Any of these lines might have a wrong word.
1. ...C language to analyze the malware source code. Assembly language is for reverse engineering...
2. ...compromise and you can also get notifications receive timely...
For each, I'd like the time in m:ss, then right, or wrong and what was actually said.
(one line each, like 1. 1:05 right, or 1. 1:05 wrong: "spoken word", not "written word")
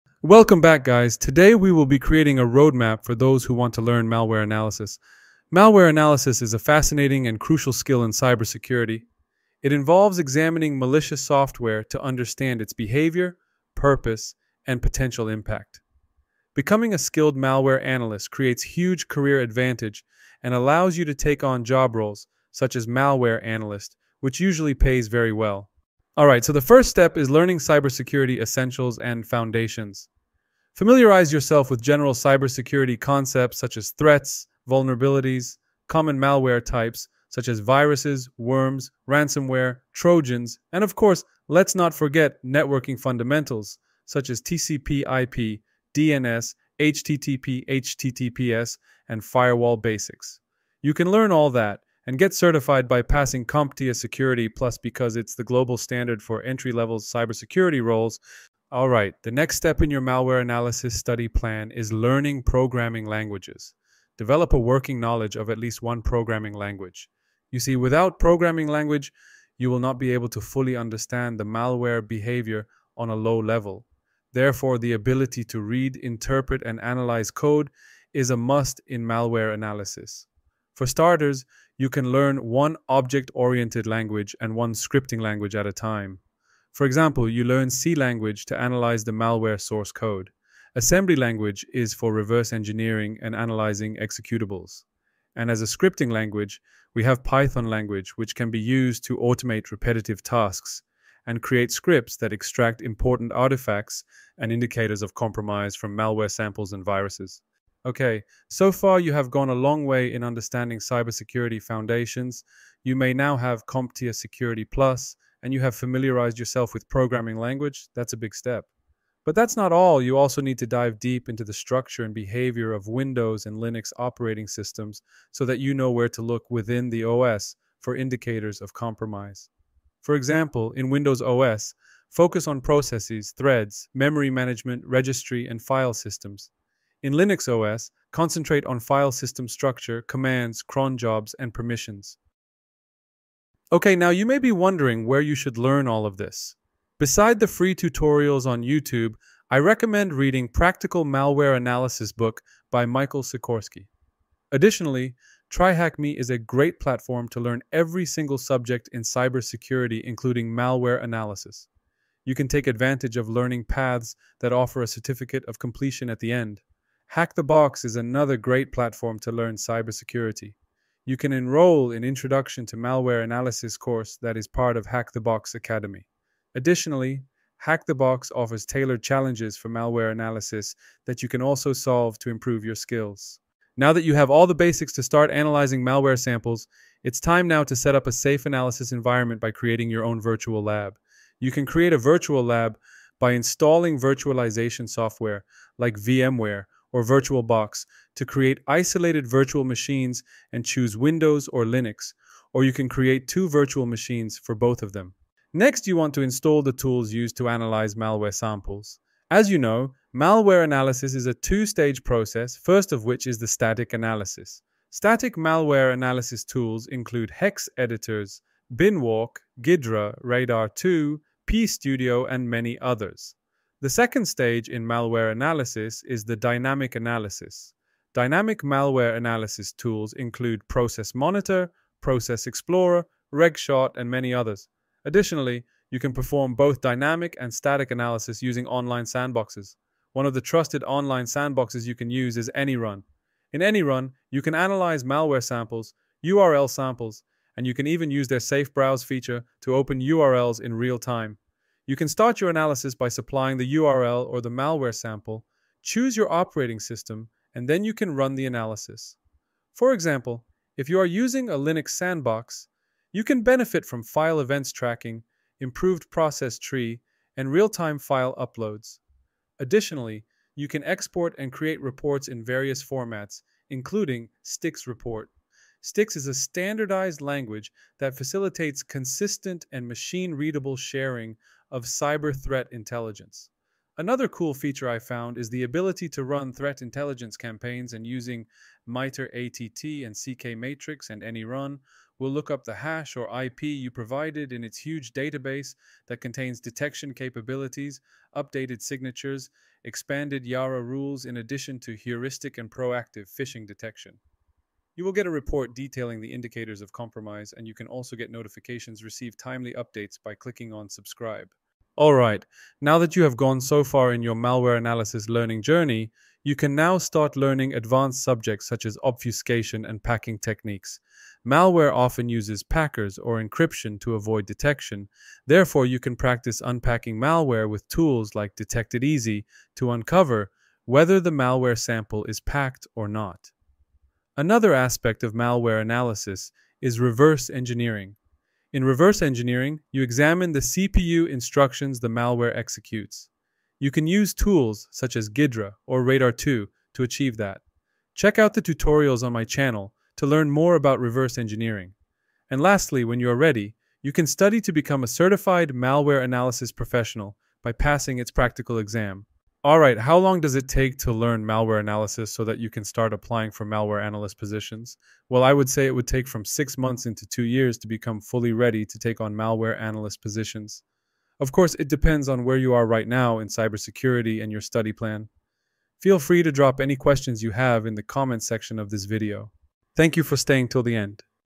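1. 1:27 right
2. 5:06 right.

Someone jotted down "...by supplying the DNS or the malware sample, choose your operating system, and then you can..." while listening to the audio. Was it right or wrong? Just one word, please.
wrong.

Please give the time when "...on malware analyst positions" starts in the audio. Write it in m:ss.
6:09.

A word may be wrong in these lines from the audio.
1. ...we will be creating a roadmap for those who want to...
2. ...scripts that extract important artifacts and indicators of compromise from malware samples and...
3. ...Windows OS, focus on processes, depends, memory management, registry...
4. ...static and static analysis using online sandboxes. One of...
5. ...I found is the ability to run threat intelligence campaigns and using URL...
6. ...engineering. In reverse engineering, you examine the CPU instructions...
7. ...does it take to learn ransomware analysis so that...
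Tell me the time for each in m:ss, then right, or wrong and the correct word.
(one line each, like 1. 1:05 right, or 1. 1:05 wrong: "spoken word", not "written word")
1. 0:01 right
2. 1:41 right
3. 2:10 wrong: "threads", not "depends"
4. 3:56 wrong: "dynamic", not "static"
5. 4:44 wrong: "MITRE", not "URL"
6. 5:37 right
7. 6:00 wrong: "malware", not "ransomware".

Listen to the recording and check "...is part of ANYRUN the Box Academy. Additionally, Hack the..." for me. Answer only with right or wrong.
wrong.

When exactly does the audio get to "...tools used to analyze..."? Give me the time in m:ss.
3:26.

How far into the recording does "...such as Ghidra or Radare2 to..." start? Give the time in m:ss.
5:44.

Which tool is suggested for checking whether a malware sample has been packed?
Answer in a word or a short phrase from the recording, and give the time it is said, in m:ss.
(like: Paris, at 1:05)
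Detect It Easy, at 5:28.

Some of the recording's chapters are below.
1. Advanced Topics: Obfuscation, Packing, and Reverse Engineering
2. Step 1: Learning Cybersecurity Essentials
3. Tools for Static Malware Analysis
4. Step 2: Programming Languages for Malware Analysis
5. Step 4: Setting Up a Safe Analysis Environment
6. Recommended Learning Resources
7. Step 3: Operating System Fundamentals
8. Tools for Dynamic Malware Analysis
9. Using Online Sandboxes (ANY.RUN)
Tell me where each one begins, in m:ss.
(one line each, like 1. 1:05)
1. 5:13
2. 0:26
3. 3:33
4. 1:01
5. 3:04
6. 2:24
7. 1:52
8. 3:44
9. 4:00.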